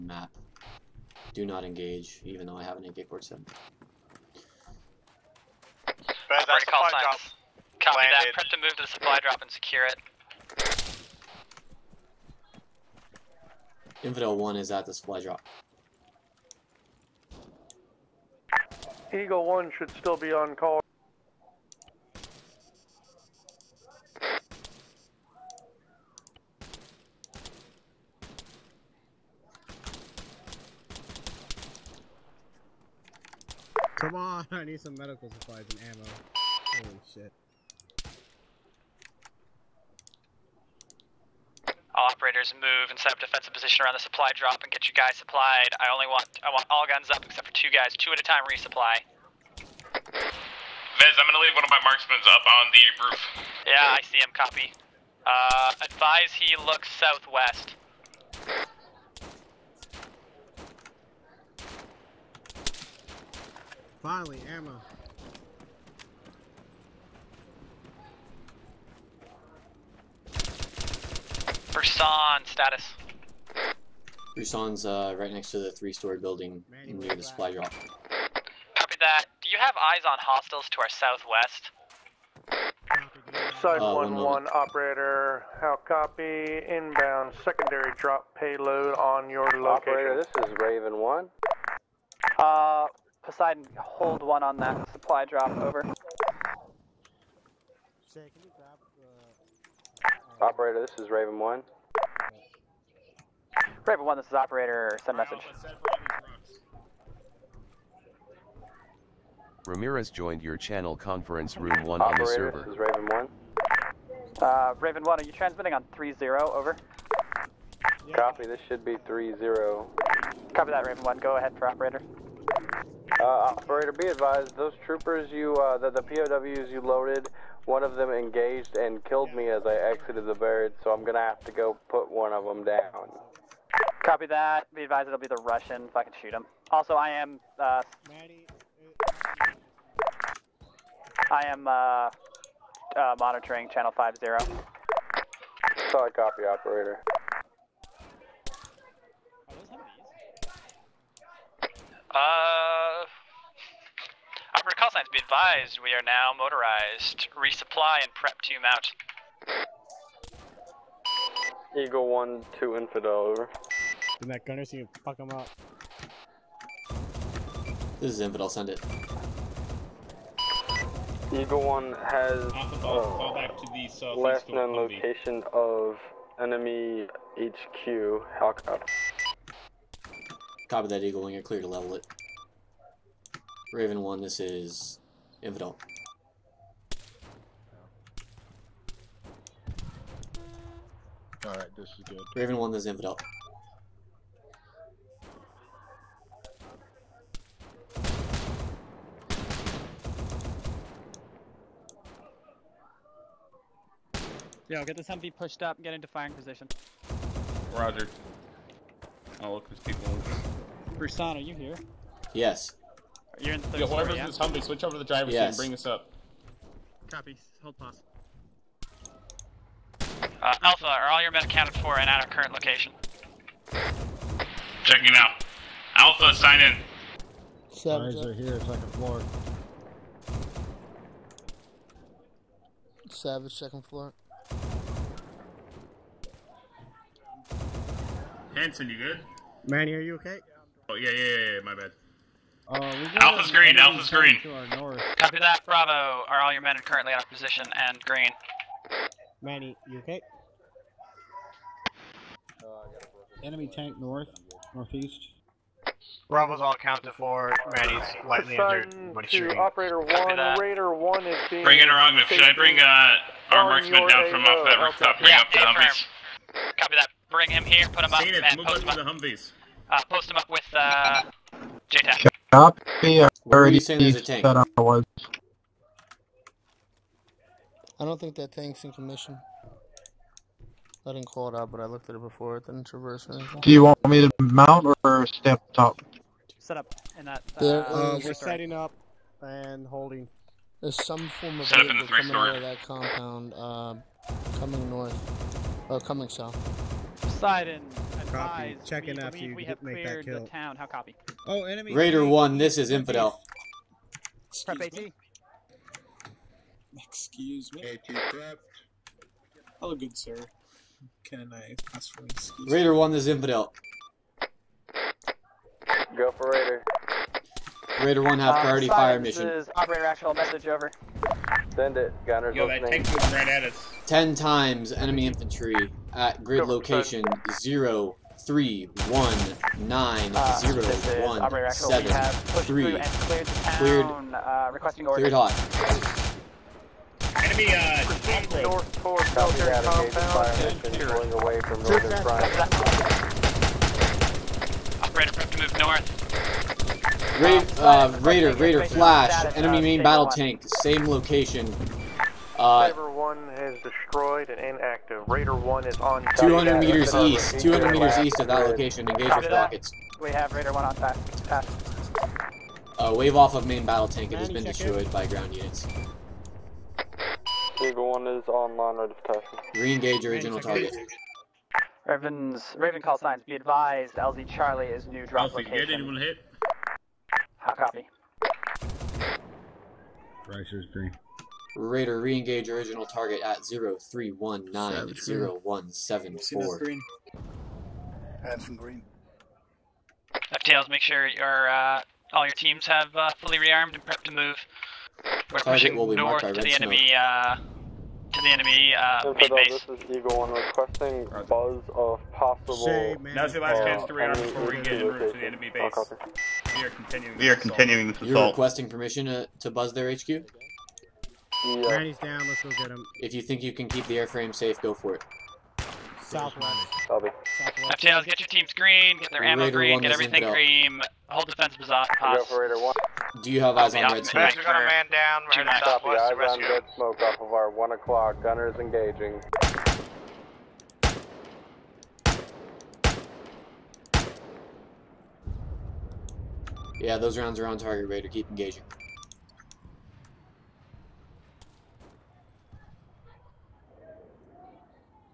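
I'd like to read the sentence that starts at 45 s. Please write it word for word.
I only want I want all guns up except for two guys, two at a time resupply.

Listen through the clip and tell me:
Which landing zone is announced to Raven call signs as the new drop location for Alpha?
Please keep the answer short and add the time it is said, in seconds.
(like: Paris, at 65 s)
LZ Charlie, at 374 s.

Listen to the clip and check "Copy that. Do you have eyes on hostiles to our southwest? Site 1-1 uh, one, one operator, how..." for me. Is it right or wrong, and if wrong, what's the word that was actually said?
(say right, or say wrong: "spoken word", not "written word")
right.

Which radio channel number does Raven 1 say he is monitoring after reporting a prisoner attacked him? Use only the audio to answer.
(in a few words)
50.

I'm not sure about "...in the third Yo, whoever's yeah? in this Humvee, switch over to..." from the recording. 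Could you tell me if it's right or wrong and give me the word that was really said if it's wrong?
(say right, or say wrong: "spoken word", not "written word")
right.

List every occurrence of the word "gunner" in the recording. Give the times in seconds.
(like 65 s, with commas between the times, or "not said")
164 s, 322 s, 428 s.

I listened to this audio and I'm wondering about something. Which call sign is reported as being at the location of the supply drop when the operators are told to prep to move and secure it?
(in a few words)
Infidel 1.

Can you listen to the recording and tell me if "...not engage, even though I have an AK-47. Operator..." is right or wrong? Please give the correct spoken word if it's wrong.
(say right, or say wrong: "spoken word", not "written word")
right.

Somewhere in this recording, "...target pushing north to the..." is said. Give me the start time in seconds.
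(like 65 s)
395 s.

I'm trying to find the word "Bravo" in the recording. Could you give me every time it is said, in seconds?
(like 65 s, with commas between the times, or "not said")
245 s, 256 s.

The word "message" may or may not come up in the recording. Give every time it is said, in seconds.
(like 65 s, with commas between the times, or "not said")
105 s, 320 s.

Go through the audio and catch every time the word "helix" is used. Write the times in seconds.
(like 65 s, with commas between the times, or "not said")
not said.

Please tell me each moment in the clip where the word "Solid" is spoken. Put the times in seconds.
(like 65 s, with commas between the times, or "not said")
145 s.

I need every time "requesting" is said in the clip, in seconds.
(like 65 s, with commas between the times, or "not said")
334 s, 400 s, 408 s.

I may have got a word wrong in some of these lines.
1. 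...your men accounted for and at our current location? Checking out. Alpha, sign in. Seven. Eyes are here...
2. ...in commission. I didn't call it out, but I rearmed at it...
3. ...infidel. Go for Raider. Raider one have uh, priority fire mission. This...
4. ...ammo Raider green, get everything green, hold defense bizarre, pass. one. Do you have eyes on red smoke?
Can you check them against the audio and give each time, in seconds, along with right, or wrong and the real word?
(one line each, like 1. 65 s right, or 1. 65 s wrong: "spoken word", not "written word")
1. 221 s right
2. 278 s wrong: "looked", not "rearmed"
3. 313 s right
4. 419 s right.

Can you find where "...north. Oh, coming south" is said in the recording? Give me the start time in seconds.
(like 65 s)
294 s.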